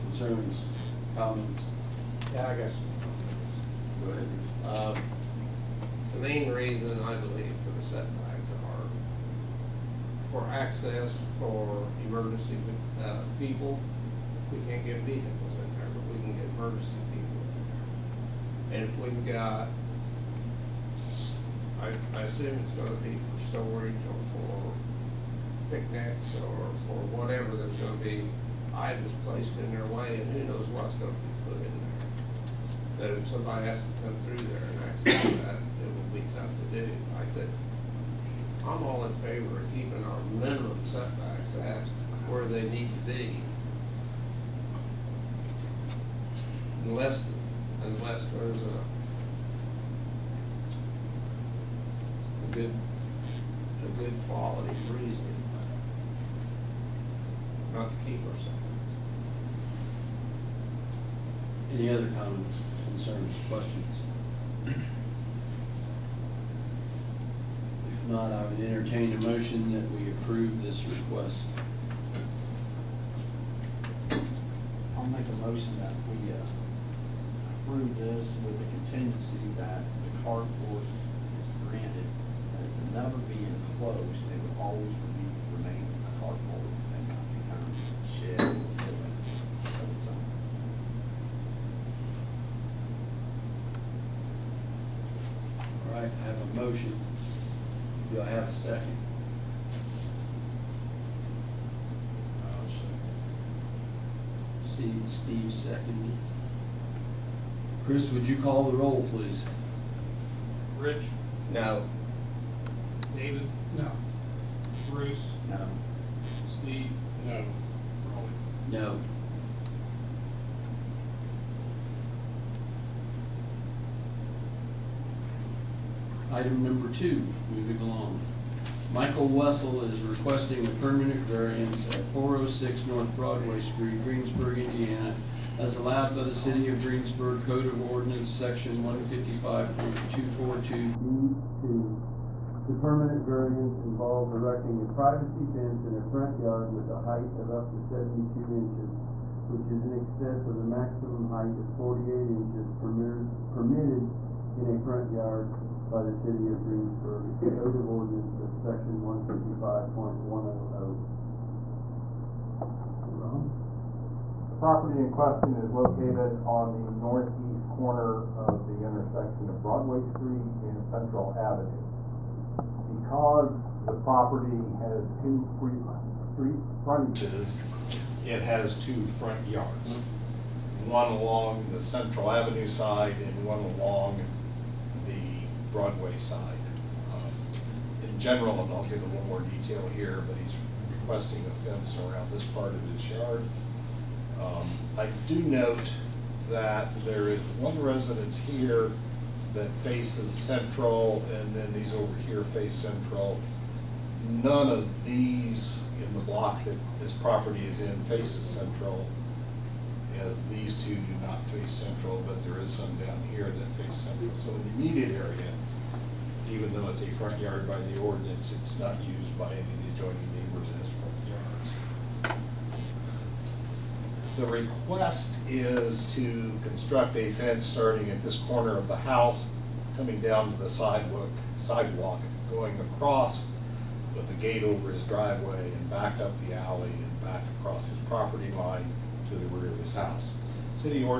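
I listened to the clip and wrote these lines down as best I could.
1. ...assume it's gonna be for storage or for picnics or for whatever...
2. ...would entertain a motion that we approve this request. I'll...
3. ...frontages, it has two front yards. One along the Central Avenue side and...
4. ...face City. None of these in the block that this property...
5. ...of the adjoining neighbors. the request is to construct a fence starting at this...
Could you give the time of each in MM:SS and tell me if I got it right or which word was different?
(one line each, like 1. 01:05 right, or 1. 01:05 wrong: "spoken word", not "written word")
1. 00:22 right
2. 01:08 right
3. 02:56 right
4. 03:22 wrong: "Central", not "City"
5. 03:39 right.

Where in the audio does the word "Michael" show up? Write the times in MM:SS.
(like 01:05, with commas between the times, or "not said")
02:08.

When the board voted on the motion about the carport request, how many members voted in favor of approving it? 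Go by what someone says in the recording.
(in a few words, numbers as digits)
0.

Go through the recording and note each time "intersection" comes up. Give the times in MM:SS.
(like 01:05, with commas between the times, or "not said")
02:48.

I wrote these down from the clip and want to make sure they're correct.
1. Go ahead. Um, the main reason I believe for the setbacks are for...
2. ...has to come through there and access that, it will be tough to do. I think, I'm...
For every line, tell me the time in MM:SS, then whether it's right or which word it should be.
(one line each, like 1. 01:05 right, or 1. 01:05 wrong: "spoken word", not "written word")
1. 00:04 right
2. 00:33 right.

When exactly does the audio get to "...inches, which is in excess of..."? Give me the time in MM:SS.
02:28.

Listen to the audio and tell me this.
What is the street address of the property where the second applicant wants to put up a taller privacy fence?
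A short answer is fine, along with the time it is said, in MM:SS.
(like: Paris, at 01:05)
406 North Broadway Street, at 02:12.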